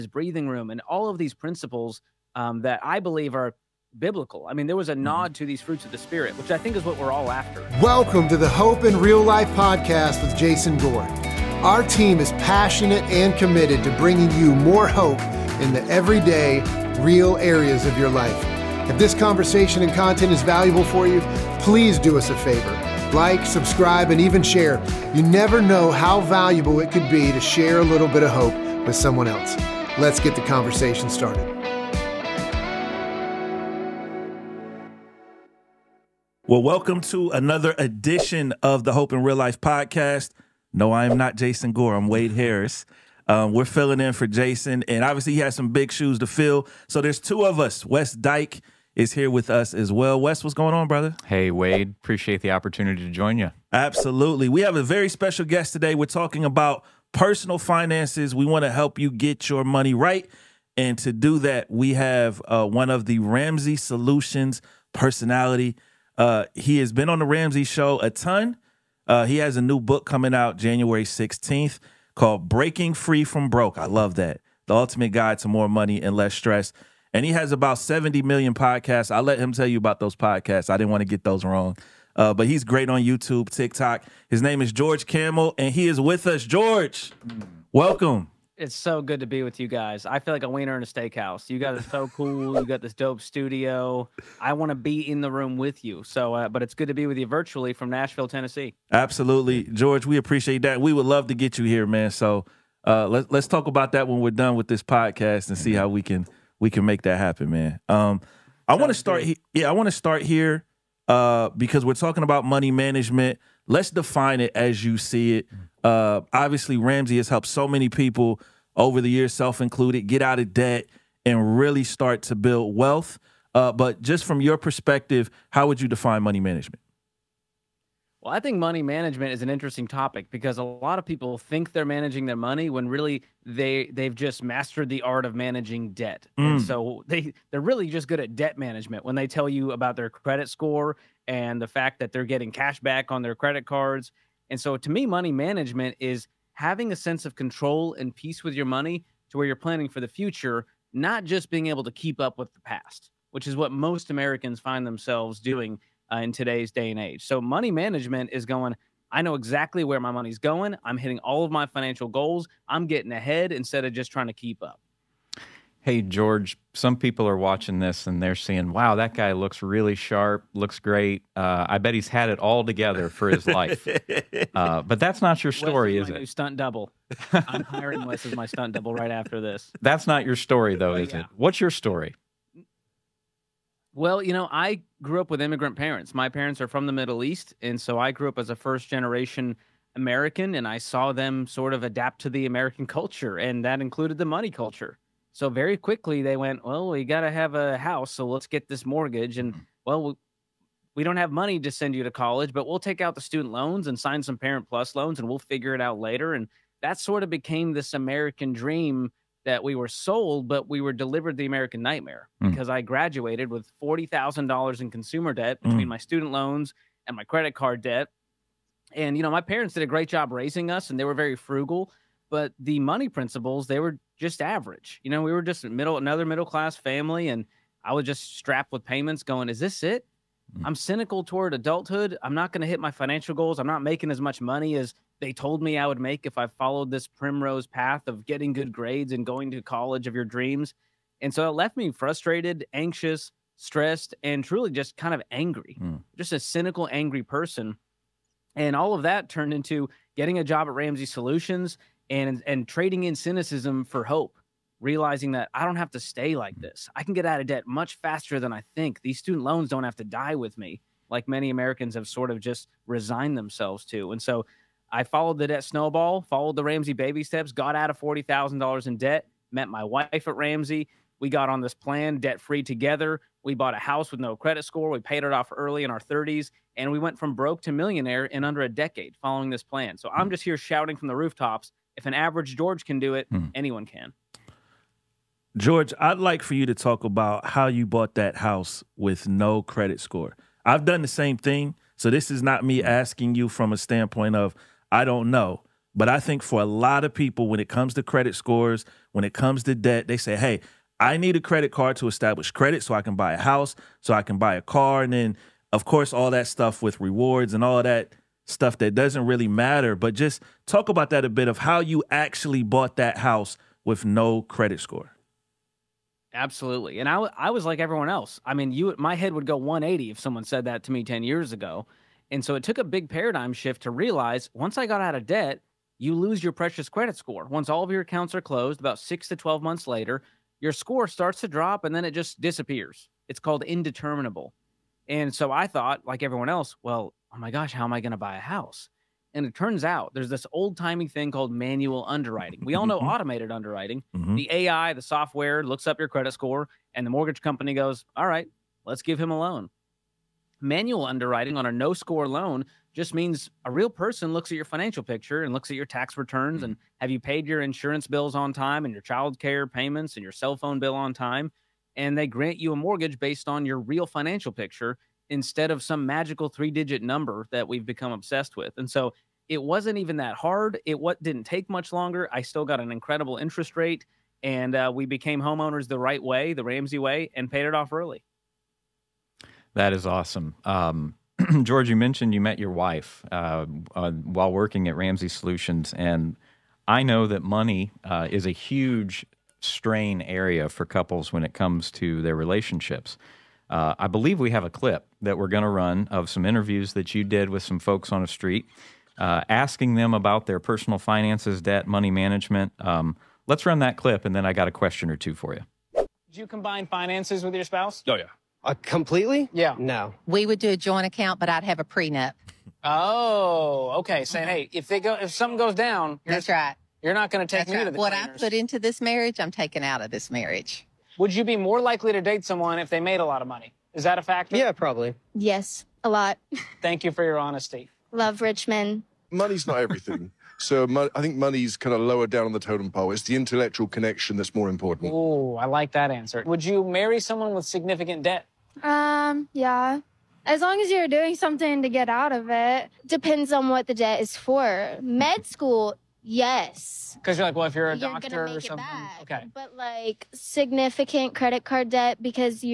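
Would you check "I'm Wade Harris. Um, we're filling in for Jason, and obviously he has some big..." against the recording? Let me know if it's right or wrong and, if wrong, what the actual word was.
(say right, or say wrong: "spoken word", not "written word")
right.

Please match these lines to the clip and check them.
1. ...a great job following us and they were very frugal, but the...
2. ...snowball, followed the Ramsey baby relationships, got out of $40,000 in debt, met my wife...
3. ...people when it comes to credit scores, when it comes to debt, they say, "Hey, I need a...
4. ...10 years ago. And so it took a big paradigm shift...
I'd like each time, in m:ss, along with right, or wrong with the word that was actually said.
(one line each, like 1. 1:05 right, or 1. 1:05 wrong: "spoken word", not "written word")
1. 3:39 wrong: "raising", not "following"
2. 4:25 wrong: "steps", not "relationships"
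3. 4:57 right
4. 5:21 right.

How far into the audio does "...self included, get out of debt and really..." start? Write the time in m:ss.
1:59.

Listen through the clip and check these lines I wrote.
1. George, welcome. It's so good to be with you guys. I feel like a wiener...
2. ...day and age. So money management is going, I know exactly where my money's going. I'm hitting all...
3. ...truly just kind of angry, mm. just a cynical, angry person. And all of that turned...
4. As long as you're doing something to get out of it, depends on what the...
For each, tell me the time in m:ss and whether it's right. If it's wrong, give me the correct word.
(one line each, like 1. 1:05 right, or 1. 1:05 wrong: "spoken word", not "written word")
1. 1:26 right
2. 2:36 right
3. 4:04 right
4. 7:20 right.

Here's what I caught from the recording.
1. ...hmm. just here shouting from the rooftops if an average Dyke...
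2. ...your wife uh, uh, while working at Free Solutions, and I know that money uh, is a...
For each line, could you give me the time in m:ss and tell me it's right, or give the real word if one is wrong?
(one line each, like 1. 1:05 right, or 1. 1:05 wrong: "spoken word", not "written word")
1. 4:40 wrong: "George", not "Dyke"
2. 6:22 wrong: "Ramsey", not "Free".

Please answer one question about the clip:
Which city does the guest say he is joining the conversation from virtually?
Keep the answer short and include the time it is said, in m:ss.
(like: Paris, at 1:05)
Nashville, Tennessee, at 1:37.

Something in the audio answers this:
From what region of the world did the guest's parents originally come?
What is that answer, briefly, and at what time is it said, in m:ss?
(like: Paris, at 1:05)
The Middle East, at 3:06.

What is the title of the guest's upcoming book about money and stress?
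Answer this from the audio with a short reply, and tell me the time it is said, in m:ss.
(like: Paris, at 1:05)
Breaking Free from Broke, at 1:12.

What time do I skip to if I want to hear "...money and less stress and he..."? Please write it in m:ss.
1:15.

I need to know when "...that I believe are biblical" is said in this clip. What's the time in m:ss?
0:02.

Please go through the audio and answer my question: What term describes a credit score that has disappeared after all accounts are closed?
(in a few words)
Indeterminable.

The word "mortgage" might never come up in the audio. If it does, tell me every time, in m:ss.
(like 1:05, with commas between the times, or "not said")
3:18, 5:47, 6:02.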